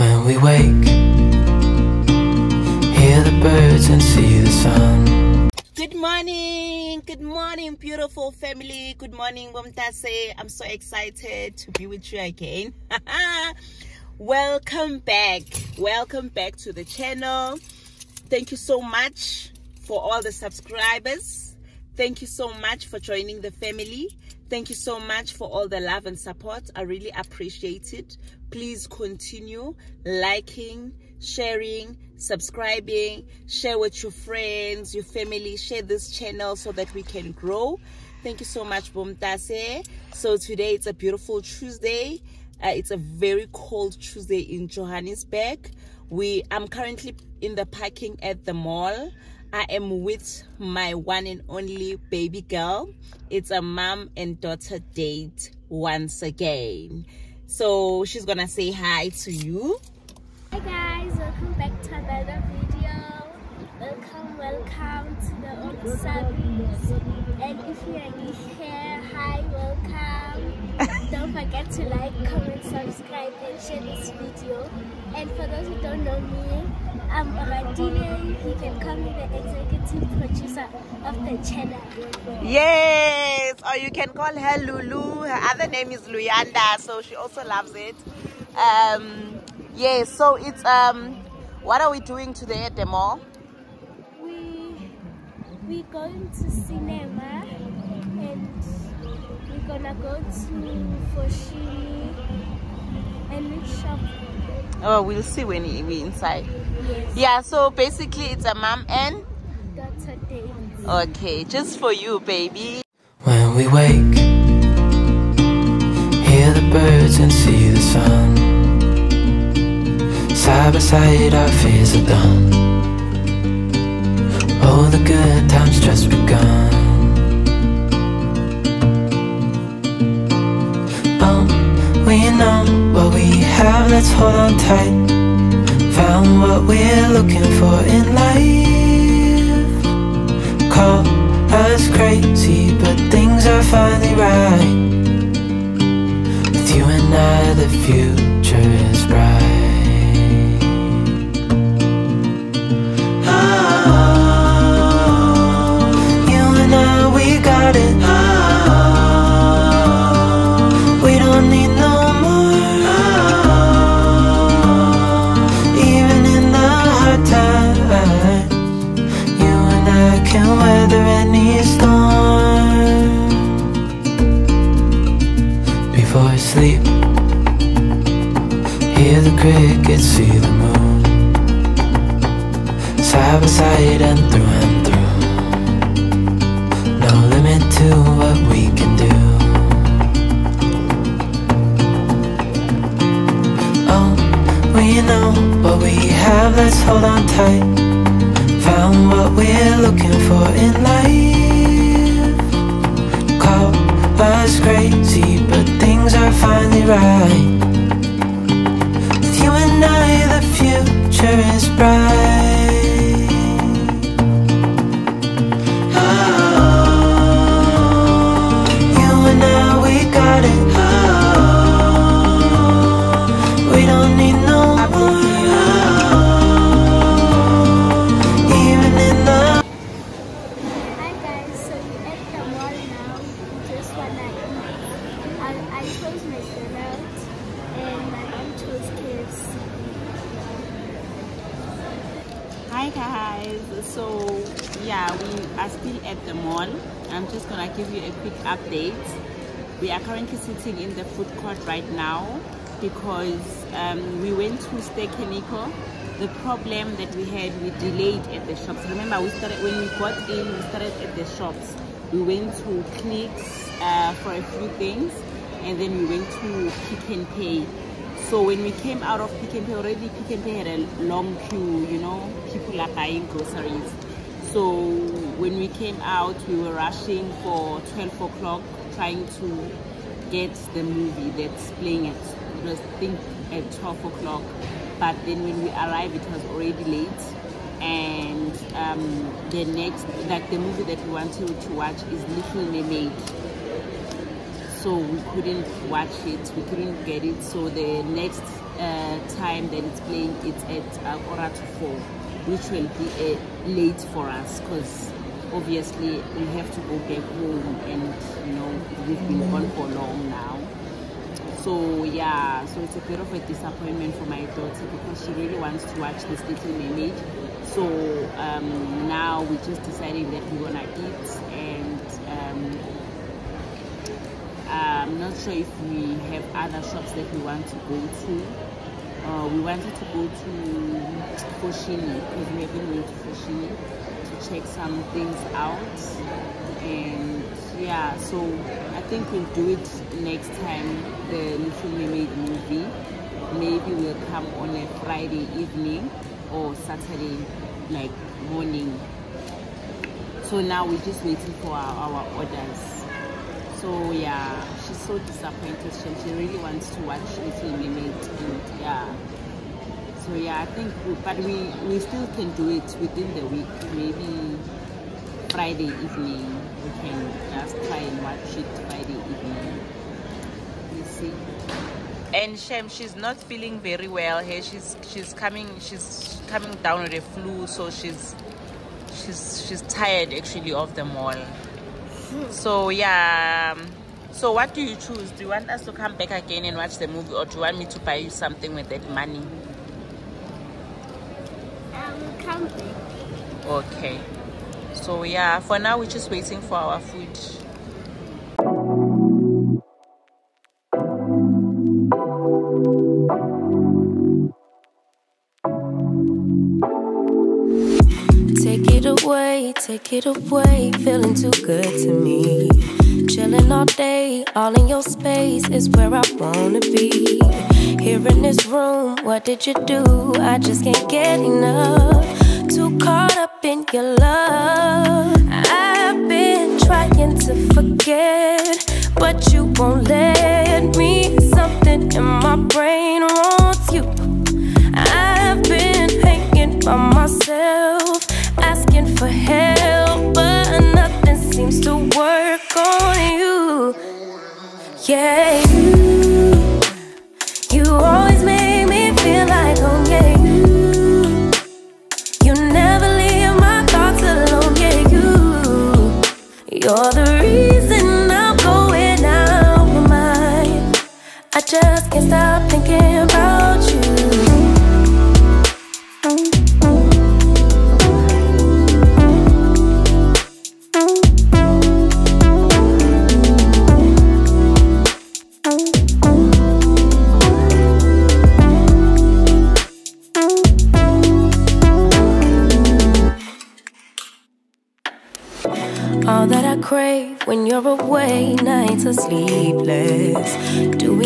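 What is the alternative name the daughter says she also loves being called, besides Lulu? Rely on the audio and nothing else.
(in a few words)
Luyanda.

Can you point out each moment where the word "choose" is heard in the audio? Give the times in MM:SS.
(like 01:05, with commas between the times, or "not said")
06:24.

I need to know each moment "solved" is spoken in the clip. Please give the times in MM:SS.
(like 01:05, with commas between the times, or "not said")
not said.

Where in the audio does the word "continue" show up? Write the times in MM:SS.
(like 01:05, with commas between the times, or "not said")
00:28.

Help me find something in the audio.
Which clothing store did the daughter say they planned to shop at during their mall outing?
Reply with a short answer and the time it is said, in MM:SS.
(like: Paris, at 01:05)
Foschini, at 01:41.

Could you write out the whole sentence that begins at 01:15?
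And for those who don't know me, I'm Oradile.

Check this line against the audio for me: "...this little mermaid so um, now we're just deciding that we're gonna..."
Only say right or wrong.
right.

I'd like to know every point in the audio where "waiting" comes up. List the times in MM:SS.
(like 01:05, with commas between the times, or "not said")
05:51, 06:36.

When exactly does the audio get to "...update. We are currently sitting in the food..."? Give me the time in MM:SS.
04:08.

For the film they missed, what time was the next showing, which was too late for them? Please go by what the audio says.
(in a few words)
quarter to four.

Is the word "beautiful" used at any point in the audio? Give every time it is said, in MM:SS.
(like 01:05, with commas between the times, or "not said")
00:07, 00:40.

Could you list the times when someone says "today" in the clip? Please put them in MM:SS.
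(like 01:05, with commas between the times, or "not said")
00:40, 01:32.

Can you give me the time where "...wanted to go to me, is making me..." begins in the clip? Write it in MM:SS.
05:29.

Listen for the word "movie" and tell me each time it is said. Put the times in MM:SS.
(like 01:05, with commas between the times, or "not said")
04:40, 04:50, 05:42, 06:27.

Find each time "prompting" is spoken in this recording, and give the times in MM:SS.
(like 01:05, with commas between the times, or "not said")
not said.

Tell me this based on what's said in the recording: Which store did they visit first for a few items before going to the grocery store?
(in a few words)
Clicks.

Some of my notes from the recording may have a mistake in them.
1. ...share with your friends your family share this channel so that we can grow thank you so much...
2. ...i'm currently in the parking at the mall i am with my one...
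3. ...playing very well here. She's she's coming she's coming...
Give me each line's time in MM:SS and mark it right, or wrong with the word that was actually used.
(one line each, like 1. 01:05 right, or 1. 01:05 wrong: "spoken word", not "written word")
1. 00:33 right
2. 00:46 right
3. 06:13 wrong: "feeling", not "playing".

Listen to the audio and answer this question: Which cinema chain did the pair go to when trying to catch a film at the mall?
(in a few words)
Ster-Kinekor.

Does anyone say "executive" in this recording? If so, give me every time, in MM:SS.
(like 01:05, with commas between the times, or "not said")
01:19.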